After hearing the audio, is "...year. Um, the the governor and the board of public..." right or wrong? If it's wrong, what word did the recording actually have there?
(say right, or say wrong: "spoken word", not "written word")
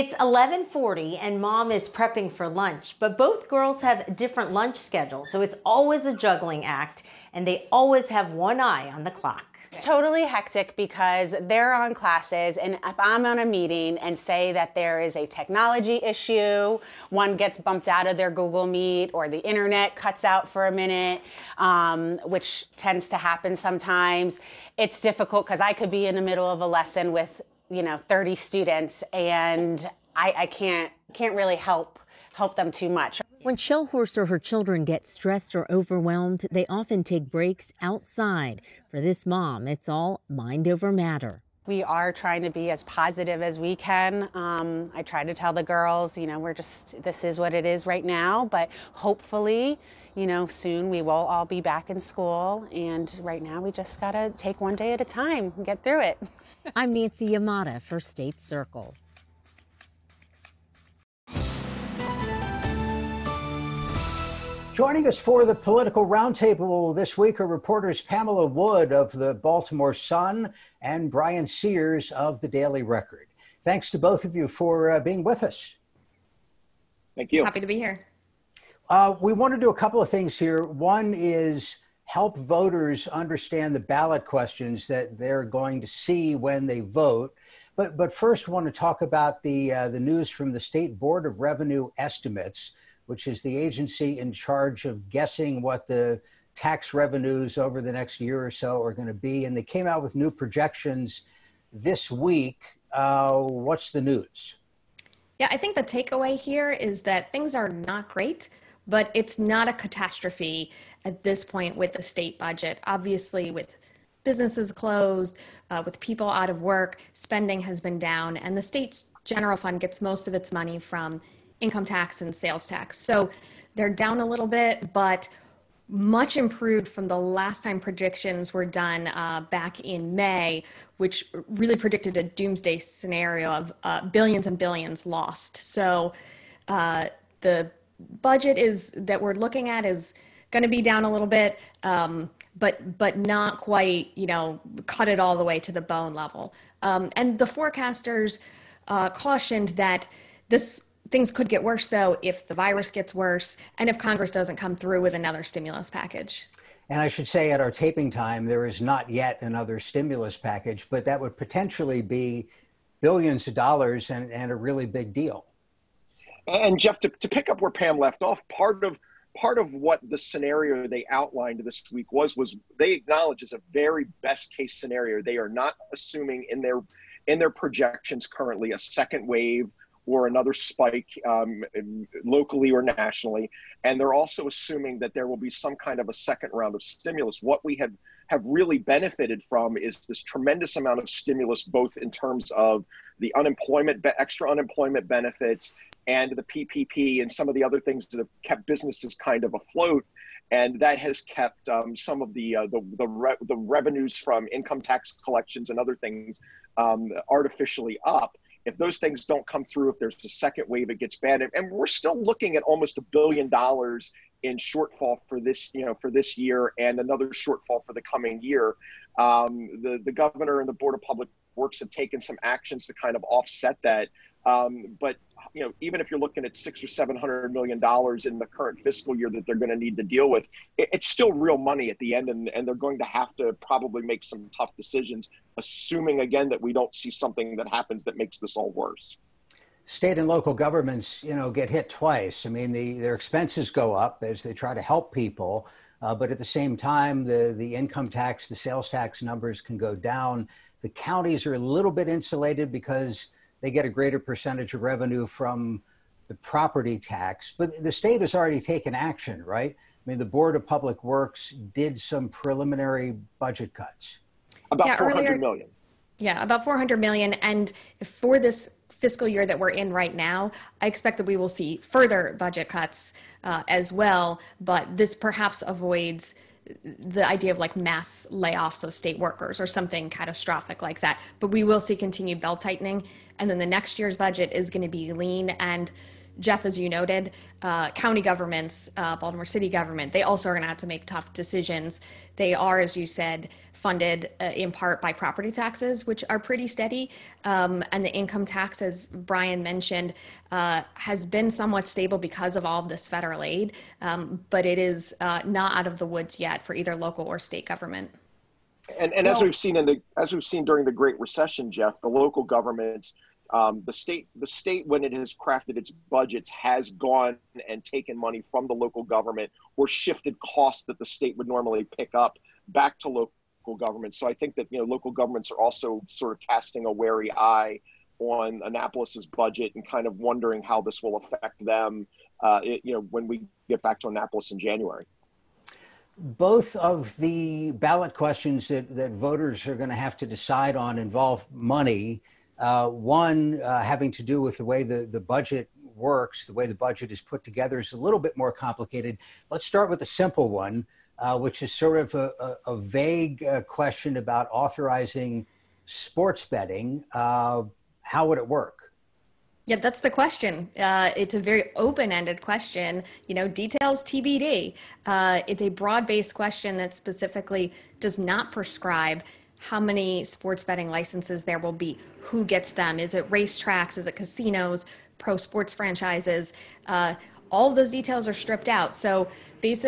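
right.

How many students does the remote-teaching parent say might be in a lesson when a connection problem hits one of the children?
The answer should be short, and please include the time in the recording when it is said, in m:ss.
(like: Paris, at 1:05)
30, at 0:27.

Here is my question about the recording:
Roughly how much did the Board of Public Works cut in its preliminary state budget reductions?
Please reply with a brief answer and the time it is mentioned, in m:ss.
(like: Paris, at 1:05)
$400 million, at 4:26.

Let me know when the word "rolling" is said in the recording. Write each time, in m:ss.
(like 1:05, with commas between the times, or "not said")
not said.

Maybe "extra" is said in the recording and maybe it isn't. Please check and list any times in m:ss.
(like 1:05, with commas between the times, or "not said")
3:14.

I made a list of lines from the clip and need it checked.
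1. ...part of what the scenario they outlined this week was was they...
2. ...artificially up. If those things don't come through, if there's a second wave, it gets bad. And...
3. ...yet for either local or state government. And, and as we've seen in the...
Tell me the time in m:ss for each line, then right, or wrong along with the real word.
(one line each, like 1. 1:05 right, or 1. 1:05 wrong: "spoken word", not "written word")
1. 2:49 right
2. 3:27 right
3. 5:06 right.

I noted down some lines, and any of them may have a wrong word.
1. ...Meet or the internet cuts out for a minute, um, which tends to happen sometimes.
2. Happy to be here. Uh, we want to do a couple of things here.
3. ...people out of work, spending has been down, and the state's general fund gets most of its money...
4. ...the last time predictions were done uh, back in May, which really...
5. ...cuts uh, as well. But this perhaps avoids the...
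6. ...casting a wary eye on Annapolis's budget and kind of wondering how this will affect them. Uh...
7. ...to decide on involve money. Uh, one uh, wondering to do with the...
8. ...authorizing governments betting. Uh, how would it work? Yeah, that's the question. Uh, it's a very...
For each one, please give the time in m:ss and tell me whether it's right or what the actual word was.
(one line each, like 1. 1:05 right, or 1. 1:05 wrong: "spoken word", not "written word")
1. 0:18 right
2. 1:17 right
3. 1:55 right
4. 2:07 right
5. 4:32 right
6. 5:26 right
7. 5:40 wrong: "having", not "wondering"
8. 5:54 wrong: "sports", not "governments".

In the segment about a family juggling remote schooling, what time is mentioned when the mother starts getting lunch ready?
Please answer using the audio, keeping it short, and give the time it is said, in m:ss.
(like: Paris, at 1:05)
11:40, at 0:00.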